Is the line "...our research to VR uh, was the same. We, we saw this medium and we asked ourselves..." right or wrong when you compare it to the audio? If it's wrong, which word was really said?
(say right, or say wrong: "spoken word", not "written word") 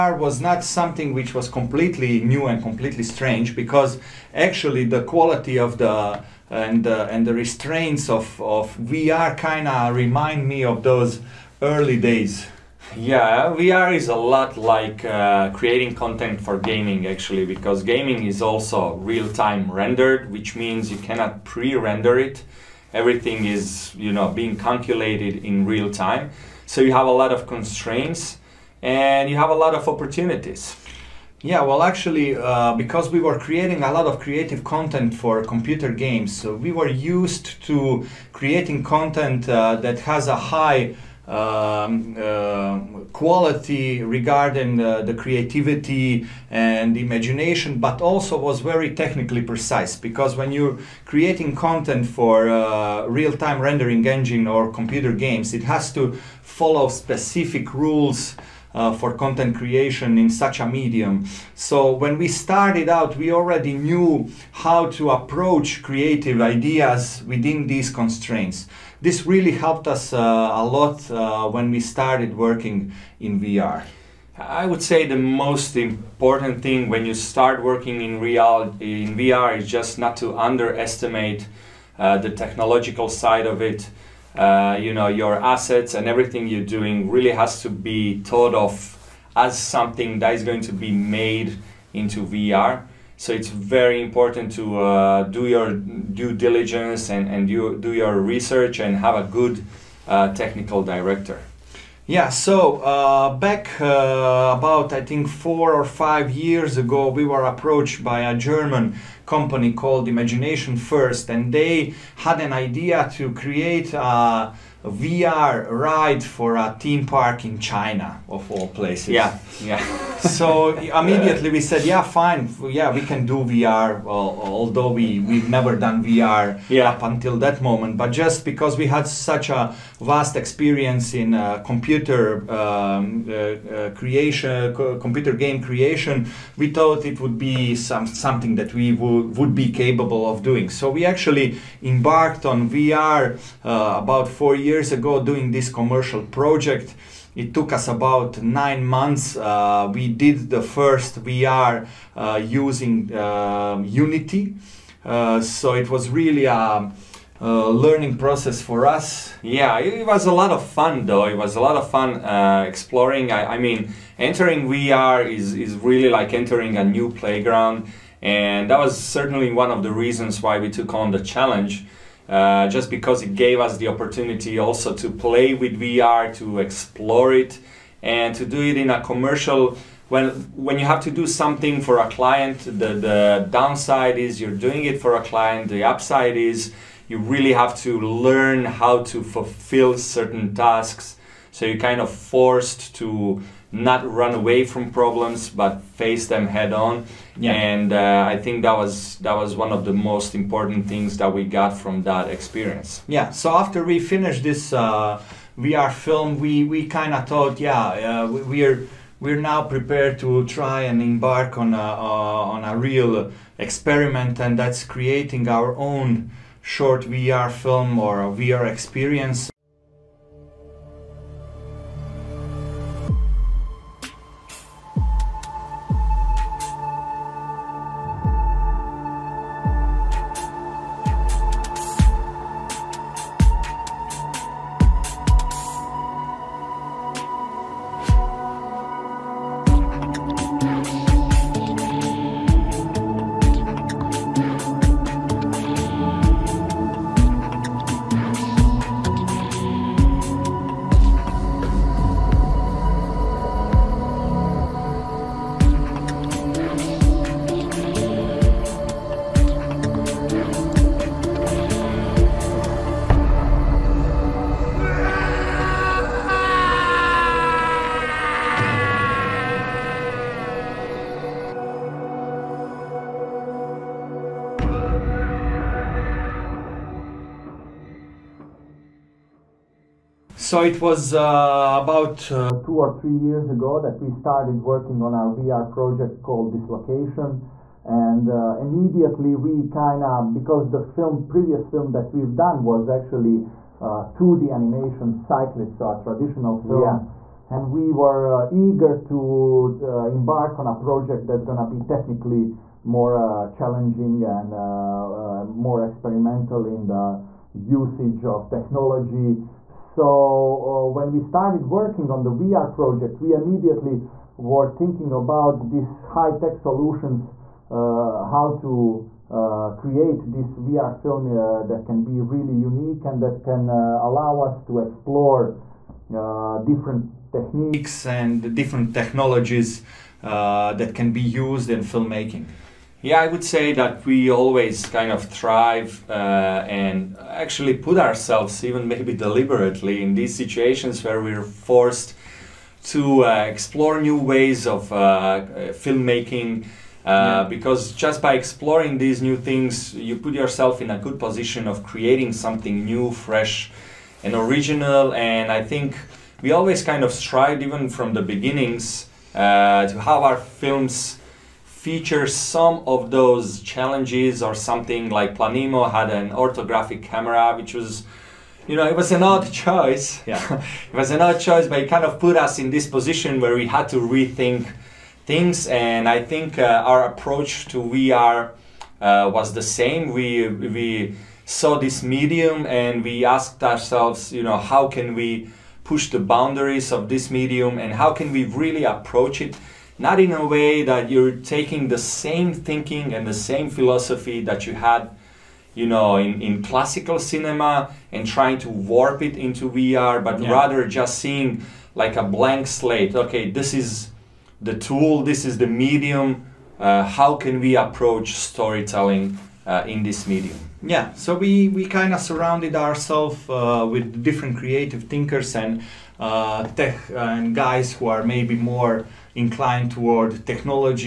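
wrong: "approach", not "research".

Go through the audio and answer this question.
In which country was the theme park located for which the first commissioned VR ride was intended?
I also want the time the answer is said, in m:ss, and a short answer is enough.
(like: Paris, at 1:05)
China, at 1:57.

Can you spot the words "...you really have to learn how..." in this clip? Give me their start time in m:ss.
3:07.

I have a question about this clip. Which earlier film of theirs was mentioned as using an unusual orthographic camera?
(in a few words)
Planemo.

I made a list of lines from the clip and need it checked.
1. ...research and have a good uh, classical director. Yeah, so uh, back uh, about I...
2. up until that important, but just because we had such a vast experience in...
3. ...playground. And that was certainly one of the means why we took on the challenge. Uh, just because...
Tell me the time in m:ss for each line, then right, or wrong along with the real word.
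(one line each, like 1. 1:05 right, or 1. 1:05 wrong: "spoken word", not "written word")
1. 1:38 wrong: "technical", not "classical"
2. 2:06 wrong: "moment", not "important"
3. 2:47 wrong: "reasons", not "means".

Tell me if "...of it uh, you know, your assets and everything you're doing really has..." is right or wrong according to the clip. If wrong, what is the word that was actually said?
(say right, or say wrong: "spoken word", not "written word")
right.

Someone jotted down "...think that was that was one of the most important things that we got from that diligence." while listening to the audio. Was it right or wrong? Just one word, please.
wrong.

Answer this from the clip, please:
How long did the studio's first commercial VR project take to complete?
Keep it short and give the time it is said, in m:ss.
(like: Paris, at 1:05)
9 months, at 2:28.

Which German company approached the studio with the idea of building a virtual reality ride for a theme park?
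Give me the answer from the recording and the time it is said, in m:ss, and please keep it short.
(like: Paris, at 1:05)
Imagination First, at 1:50.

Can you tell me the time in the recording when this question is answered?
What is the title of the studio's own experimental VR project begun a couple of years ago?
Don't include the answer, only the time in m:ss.
4:46.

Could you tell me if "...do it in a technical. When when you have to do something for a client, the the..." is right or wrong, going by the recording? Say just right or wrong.
wrong.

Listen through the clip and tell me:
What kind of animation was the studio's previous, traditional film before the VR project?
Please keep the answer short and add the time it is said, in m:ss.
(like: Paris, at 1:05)
2D animation, at 4:53.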